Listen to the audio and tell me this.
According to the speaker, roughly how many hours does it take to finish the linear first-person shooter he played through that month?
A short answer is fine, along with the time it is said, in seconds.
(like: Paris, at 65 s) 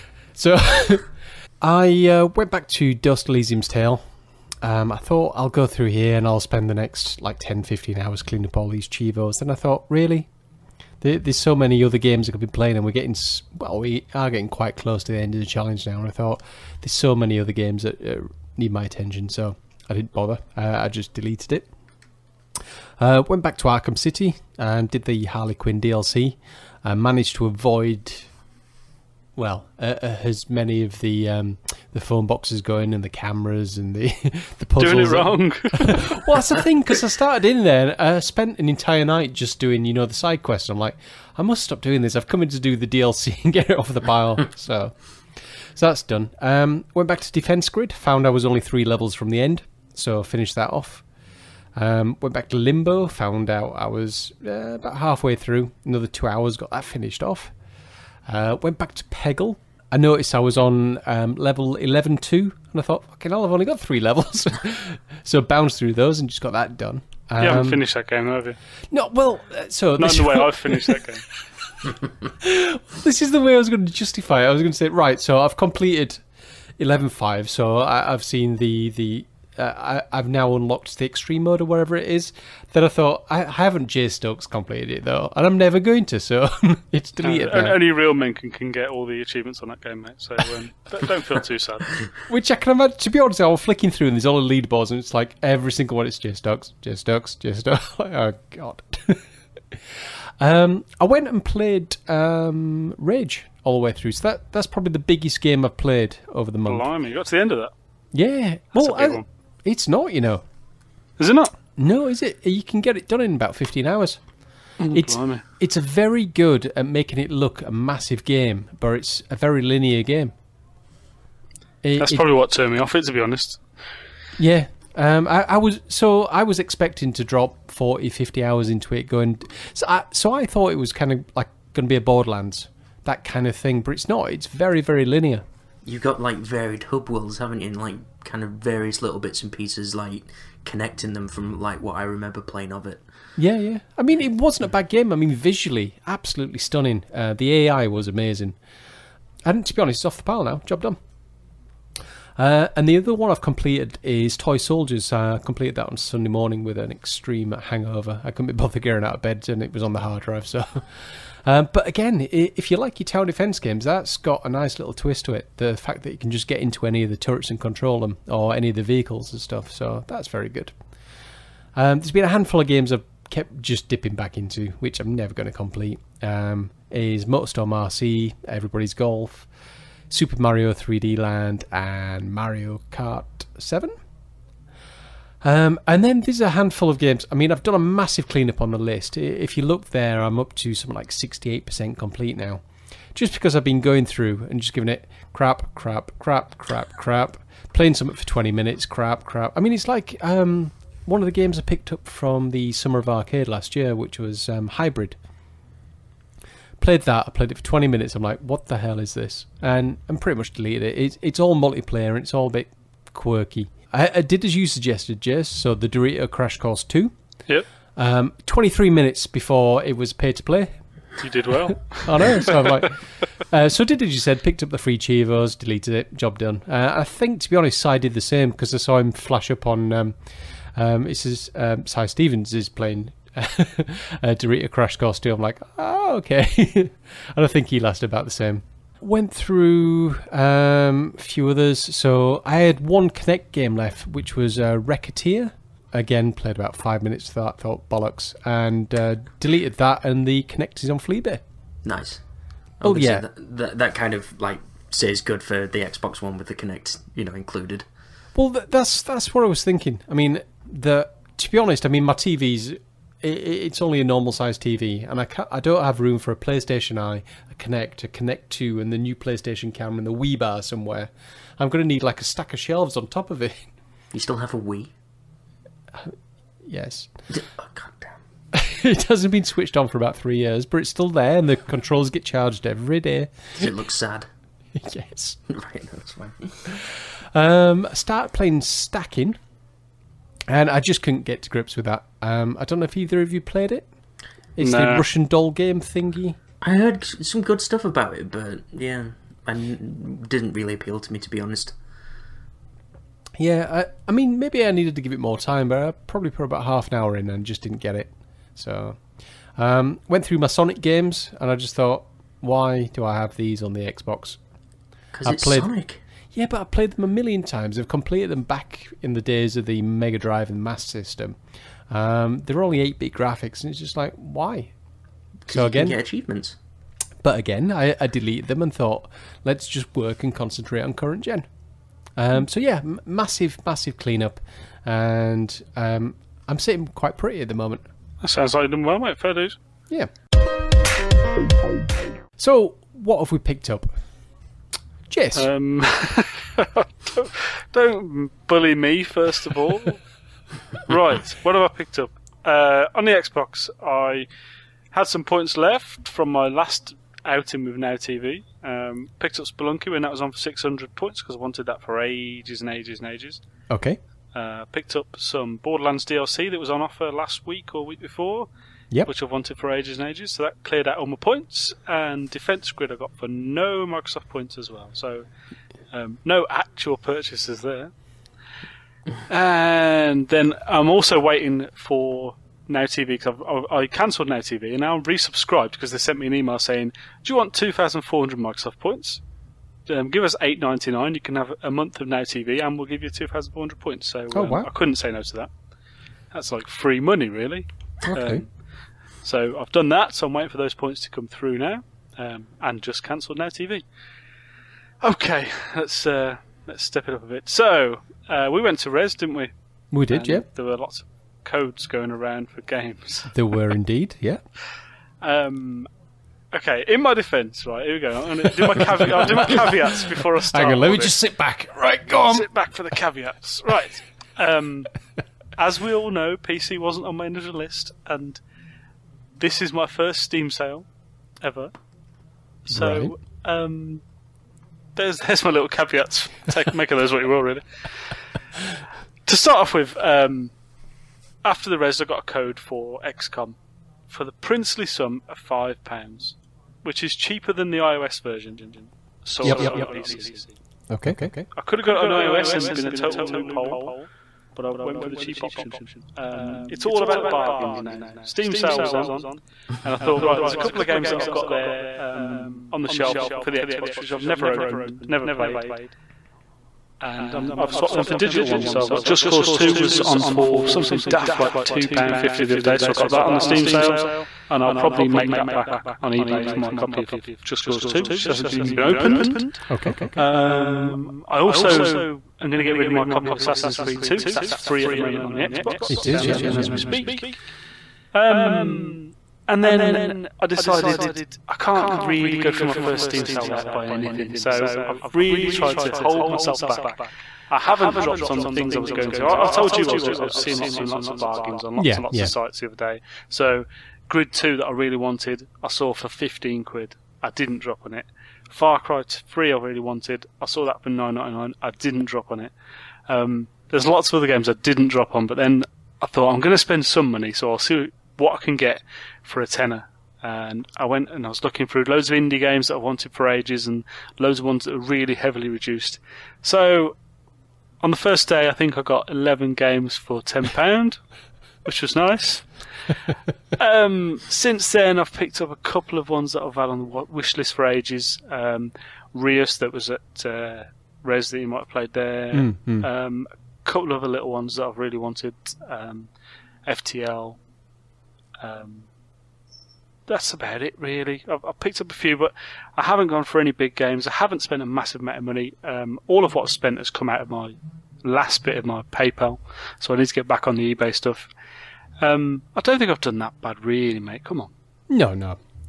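15, at 113 s.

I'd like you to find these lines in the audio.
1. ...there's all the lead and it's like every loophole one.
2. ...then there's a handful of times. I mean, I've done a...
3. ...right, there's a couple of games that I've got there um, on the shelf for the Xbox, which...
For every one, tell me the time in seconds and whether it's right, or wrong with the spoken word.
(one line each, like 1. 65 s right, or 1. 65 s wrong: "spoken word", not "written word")
1. 94 s wrong: "single", not "loophole"
2. 186 s wrong: "games", not "times"
3. 460 s right.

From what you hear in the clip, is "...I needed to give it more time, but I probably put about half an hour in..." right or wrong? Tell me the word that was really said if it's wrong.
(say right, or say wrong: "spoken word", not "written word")
right.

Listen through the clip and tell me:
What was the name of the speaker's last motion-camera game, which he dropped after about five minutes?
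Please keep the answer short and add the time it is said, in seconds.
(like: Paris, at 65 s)
Racketeer, at 244 s.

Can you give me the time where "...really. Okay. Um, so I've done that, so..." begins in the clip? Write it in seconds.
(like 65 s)
397 s.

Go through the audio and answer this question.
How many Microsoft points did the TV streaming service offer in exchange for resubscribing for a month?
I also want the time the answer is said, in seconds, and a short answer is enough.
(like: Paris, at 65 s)
2,400, at 387 s.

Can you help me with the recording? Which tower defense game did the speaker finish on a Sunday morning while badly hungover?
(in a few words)
Toy Soldiers.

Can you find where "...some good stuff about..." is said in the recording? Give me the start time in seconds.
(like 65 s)
297 s.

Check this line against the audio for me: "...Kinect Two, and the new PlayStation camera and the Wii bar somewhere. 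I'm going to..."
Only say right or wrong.
right.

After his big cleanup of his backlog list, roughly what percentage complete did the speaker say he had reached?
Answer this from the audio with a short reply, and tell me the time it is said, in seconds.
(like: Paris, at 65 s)
68%, at 191 s.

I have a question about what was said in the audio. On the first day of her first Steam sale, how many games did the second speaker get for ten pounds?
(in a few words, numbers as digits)
11.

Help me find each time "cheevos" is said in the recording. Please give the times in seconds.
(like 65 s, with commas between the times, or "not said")
8 s, 224 s.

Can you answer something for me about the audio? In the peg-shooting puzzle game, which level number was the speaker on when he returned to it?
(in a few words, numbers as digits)
11.2.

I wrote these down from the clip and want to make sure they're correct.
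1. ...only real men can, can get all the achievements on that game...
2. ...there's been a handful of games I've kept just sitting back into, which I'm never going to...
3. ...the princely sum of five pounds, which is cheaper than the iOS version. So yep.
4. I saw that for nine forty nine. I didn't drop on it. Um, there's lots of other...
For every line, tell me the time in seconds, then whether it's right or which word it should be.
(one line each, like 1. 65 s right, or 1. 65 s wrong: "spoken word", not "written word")
1. 87 s right
2. 171 s wrong: "dipping", not "sitting"
3. 444 s right
4. 510 s wrong: "ninety", not "forty".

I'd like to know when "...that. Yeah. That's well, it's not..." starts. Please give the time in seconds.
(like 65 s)
107 s.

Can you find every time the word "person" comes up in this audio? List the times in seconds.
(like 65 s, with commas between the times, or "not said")
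not said.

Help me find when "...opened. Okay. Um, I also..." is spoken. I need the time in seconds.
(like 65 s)
478 s.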